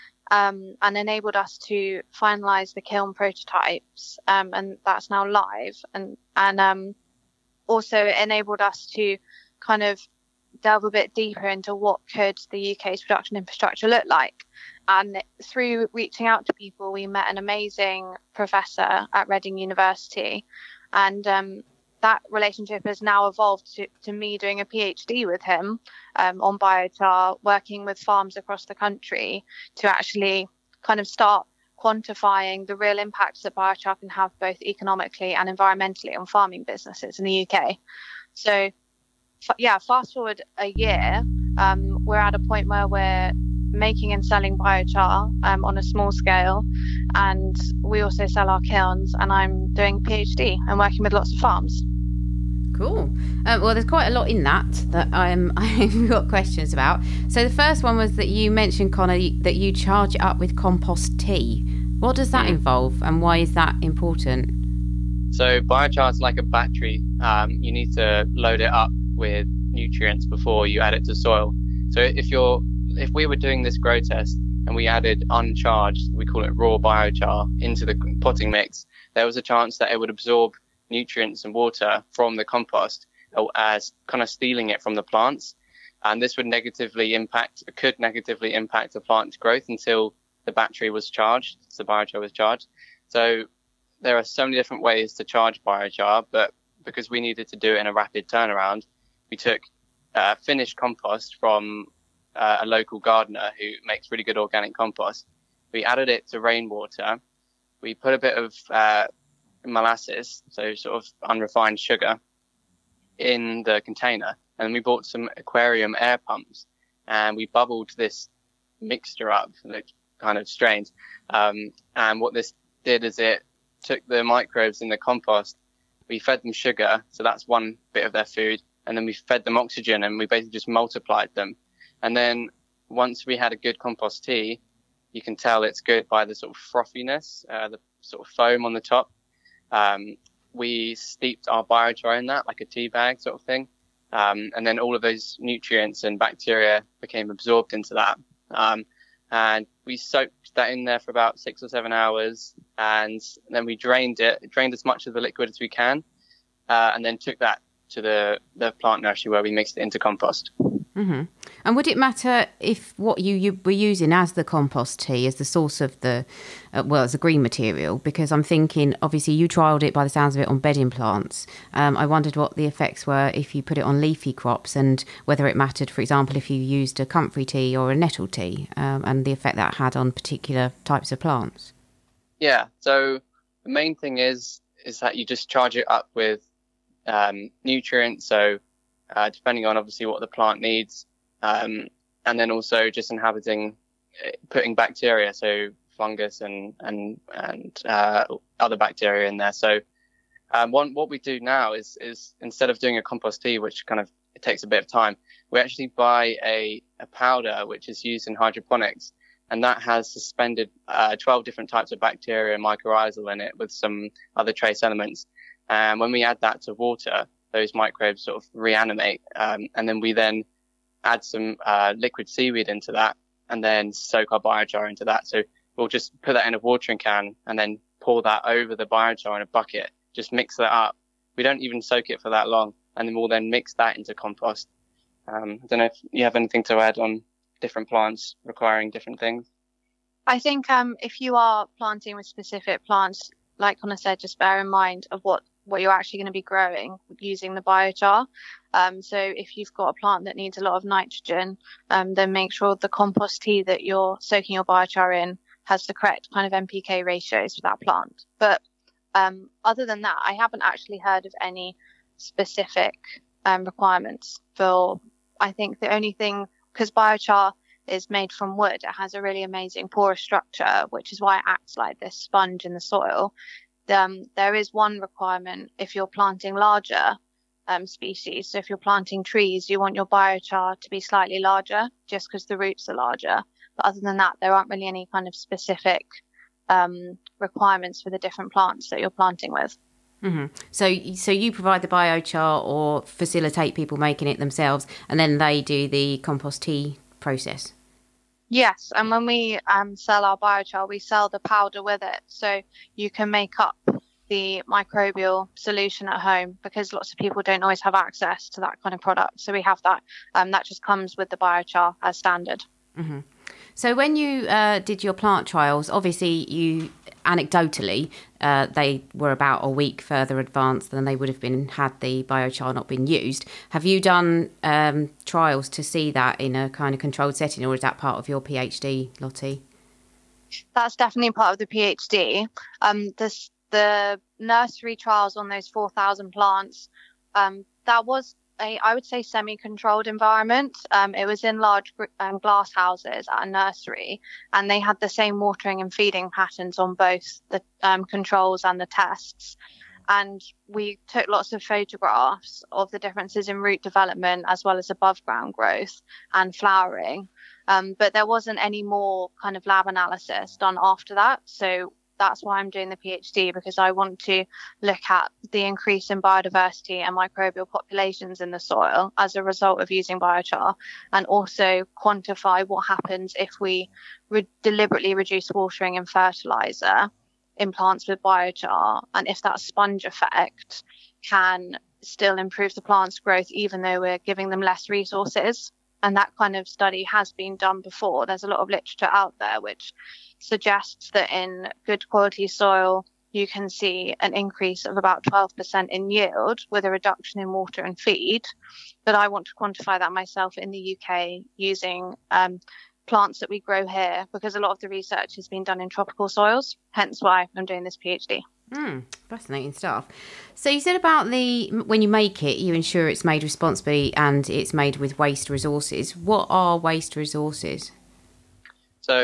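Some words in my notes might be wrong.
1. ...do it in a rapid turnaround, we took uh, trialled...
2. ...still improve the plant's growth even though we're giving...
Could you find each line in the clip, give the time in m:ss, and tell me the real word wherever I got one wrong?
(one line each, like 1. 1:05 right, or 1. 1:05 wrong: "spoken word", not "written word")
1. 1:37 wrong: "finished", not "trialled"
2. 6:22 right.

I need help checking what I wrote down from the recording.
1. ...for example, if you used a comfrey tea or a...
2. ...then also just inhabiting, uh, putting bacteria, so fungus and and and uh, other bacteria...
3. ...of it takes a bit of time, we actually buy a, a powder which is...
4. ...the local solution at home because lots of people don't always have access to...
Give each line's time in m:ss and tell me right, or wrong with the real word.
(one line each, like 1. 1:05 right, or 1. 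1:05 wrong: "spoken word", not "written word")
1. 2:55 right
2. 3:12 right
3. 3:23 right
4. 5:04 wrong: "microbial", not "local".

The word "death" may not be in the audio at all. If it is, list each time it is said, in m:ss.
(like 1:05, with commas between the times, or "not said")
not said.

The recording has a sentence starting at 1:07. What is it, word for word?
Um, you need to load it up with nutrients before you add it to soil.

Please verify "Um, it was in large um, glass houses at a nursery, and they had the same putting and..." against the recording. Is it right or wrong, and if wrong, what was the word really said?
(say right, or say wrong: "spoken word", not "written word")
wrong: "watering", not "putting".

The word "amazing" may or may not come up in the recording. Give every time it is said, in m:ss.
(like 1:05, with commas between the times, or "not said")
0:17, 4:29.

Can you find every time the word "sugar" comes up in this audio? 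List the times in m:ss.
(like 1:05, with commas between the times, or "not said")
1:51, 2:06.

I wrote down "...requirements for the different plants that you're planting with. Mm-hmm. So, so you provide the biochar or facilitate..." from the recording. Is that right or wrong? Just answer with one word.
right.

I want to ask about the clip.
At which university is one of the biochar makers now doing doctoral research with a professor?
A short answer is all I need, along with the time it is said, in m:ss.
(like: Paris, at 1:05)
Reading University, at 0:19.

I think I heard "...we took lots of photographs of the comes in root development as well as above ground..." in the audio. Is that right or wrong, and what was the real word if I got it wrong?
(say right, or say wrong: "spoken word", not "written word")
wrong: "differences", not "comes".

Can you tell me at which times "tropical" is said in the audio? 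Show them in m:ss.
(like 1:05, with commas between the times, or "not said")
6:45.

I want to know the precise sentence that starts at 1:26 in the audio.
And this would negatively impact, could negatively impact the plant's growth until the battery was charged, the biochar was charged.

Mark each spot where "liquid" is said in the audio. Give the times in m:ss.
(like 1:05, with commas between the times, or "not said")
2:35, 3:41.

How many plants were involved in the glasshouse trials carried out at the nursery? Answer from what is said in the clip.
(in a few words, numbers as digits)
4,000.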